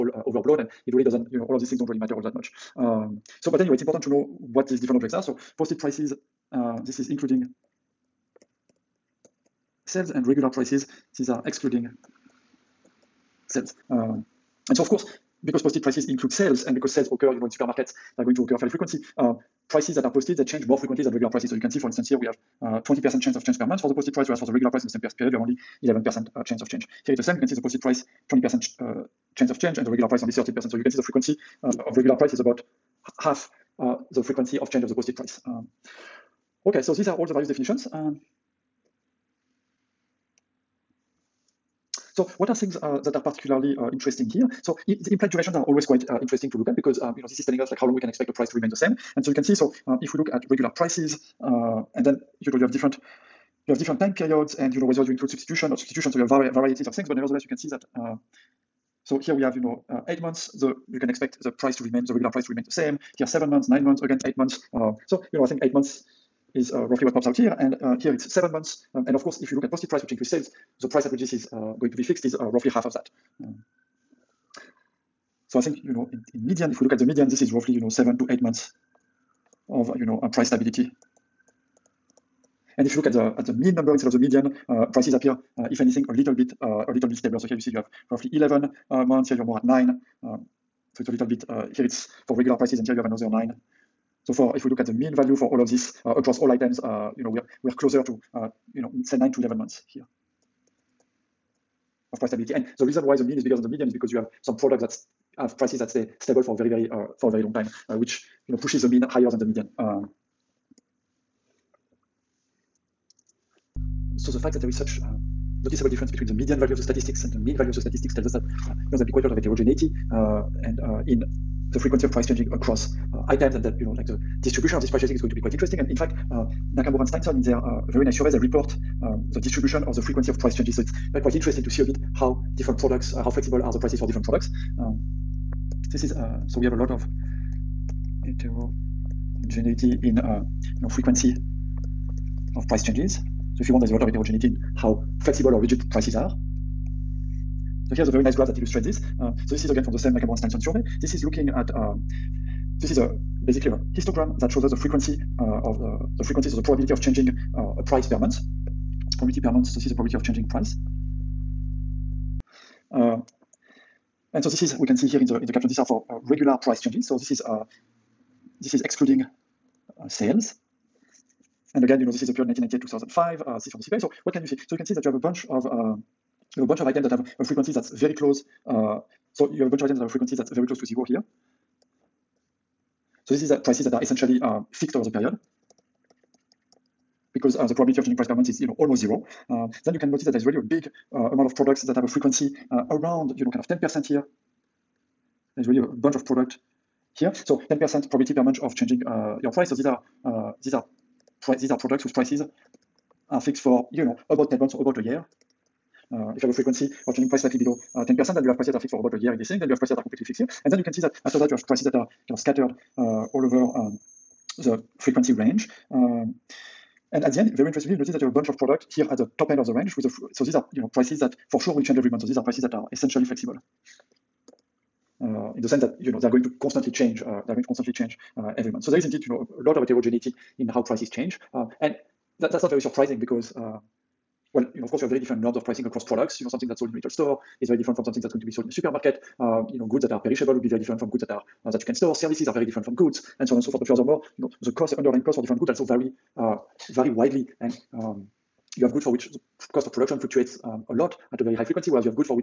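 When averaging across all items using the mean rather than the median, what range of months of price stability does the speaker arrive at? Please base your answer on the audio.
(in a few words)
9 to 11 months.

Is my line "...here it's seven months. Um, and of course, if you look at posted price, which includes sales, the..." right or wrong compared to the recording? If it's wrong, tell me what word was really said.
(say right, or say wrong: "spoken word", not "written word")
right.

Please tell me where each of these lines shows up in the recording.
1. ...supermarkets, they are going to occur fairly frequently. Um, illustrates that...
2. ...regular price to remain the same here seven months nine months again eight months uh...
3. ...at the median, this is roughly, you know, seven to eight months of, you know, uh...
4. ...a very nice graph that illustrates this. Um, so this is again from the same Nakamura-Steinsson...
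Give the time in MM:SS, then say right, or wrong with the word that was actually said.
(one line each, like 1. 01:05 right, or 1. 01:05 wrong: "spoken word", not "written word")
1. 00:17 wrong: "prices", not "illustrates"
2. 01:02 right
3. 01:16 right
4. 02:28 right.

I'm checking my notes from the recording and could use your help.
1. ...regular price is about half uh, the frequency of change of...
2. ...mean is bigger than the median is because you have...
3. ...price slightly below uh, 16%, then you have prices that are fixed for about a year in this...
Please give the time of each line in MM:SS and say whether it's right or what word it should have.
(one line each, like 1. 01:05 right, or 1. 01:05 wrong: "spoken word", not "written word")
1. 00:31 right
2. 01:43 right
3. 03:27 wrong: "10", not "16".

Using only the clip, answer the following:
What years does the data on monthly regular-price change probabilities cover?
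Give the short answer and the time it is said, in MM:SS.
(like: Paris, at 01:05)
1998-2005, at 02:52.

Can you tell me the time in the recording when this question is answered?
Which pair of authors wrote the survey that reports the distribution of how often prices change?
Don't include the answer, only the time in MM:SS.
02:06.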